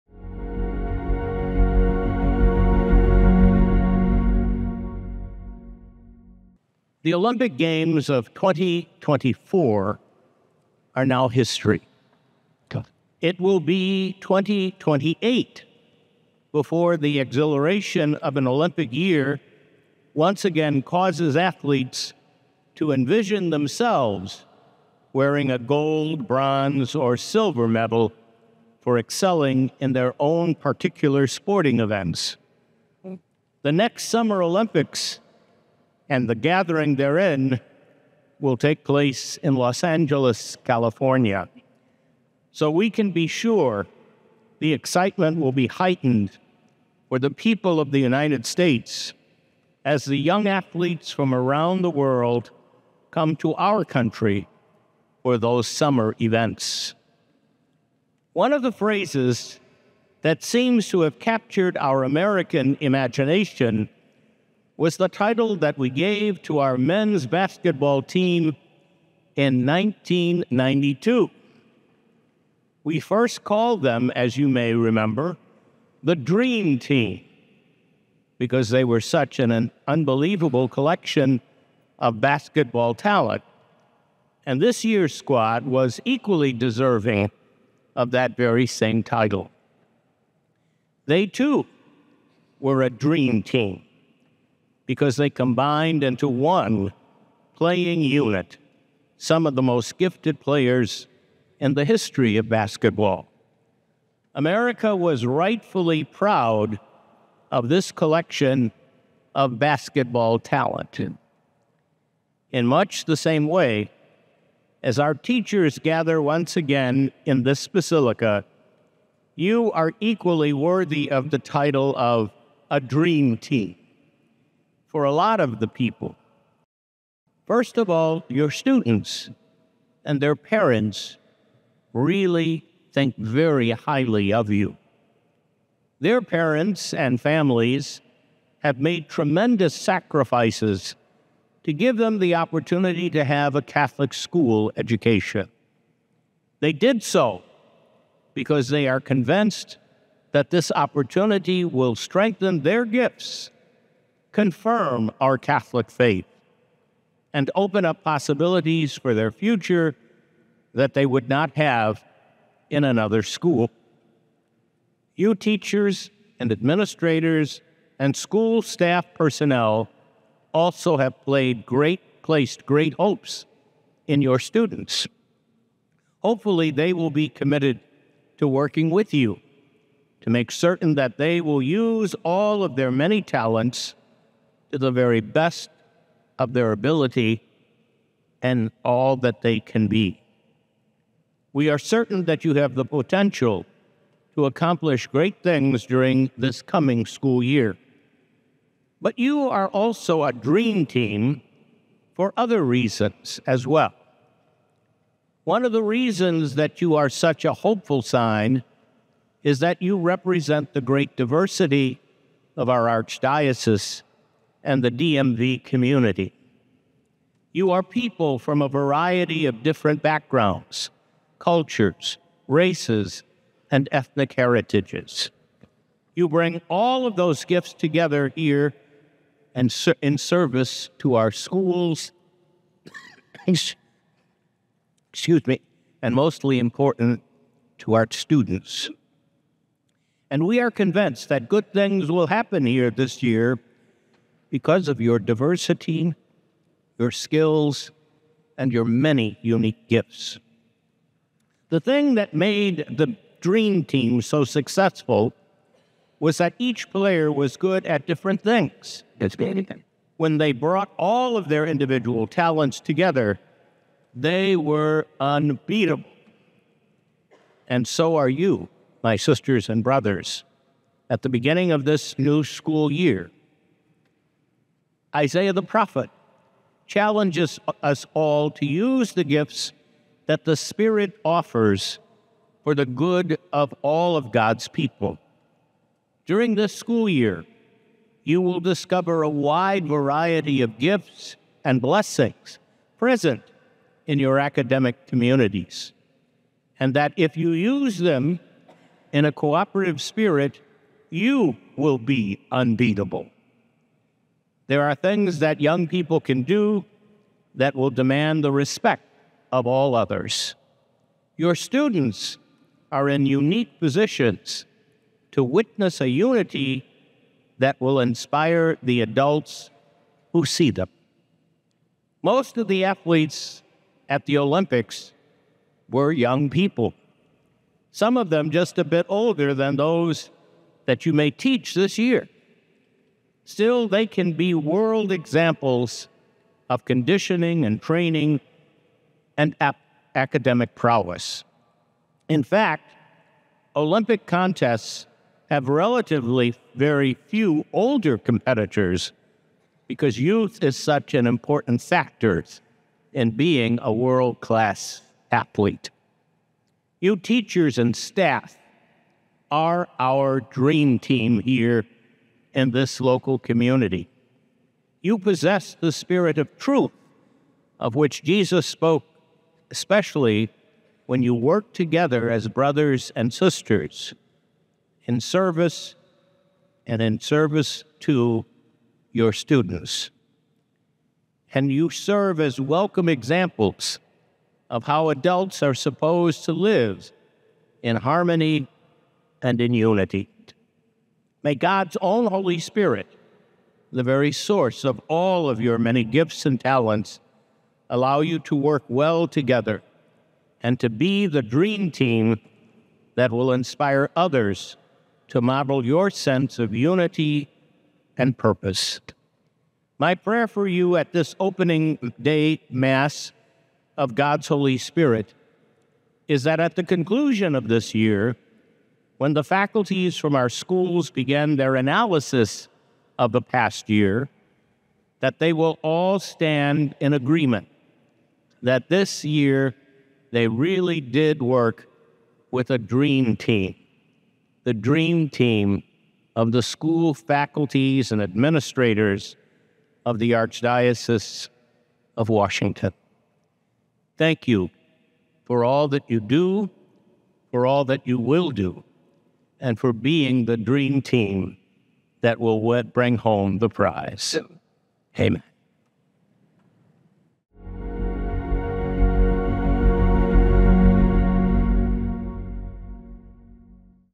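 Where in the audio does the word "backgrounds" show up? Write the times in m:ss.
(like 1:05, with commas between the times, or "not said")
3:40.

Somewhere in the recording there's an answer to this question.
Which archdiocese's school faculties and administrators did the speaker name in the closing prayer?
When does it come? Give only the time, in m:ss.
7:22.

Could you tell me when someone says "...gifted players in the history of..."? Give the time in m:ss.
1:39.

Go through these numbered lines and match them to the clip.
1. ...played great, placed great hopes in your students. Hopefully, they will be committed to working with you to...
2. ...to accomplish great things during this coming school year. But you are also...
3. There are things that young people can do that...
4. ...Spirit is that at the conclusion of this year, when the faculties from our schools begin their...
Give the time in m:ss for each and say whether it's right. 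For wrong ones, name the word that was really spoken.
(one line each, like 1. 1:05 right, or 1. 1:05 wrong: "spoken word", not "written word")
1. 2:51 right
2. 3:14 right
3. 5:04 right
4. 6:54 right.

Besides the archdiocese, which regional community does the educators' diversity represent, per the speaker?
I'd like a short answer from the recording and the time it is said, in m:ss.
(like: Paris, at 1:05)
DMV, at 3:34.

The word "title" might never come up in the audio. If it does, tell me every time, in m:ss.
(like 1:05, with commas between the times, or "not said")
1:05, 1:29, 2:01.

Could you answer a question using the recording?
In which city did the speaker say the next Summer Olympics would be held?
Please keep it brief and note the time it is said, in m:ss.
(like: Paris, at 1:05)
Los Angeles, at 0:39.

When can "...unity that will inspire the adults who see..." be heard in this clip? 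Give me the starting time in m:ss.
5:16.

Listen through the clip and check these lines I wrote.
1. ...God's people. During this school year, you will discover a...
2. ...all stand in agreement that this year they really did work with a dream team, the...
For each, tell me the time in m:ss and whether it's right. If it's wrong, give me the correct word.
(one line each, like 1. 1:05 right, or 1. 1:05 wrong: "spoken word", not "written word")
1. 4:44 right
2. 7:05 right.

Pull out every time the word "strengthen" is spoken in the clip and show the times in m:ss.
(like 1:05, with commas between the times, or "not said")
2:31.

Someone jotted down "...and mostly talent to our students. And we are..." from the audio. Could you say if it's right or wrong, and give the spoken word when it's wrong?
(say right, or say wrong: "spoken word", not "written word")
wrong: "important", not "talent".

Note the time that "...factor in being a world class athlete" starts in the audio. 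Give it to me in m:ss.
5:51.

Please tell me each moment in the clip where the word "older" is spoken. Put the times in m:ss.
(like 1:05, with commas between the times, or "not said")
5:29, 5:47.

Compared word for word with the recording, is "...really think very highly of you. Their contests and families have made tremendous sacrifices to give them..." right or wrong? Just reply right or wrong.
wrong.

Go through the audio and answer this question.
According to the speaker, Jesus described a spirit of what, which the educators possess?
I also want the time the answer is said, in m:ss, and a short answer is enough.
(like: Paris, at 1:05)
Truth, at 6:06.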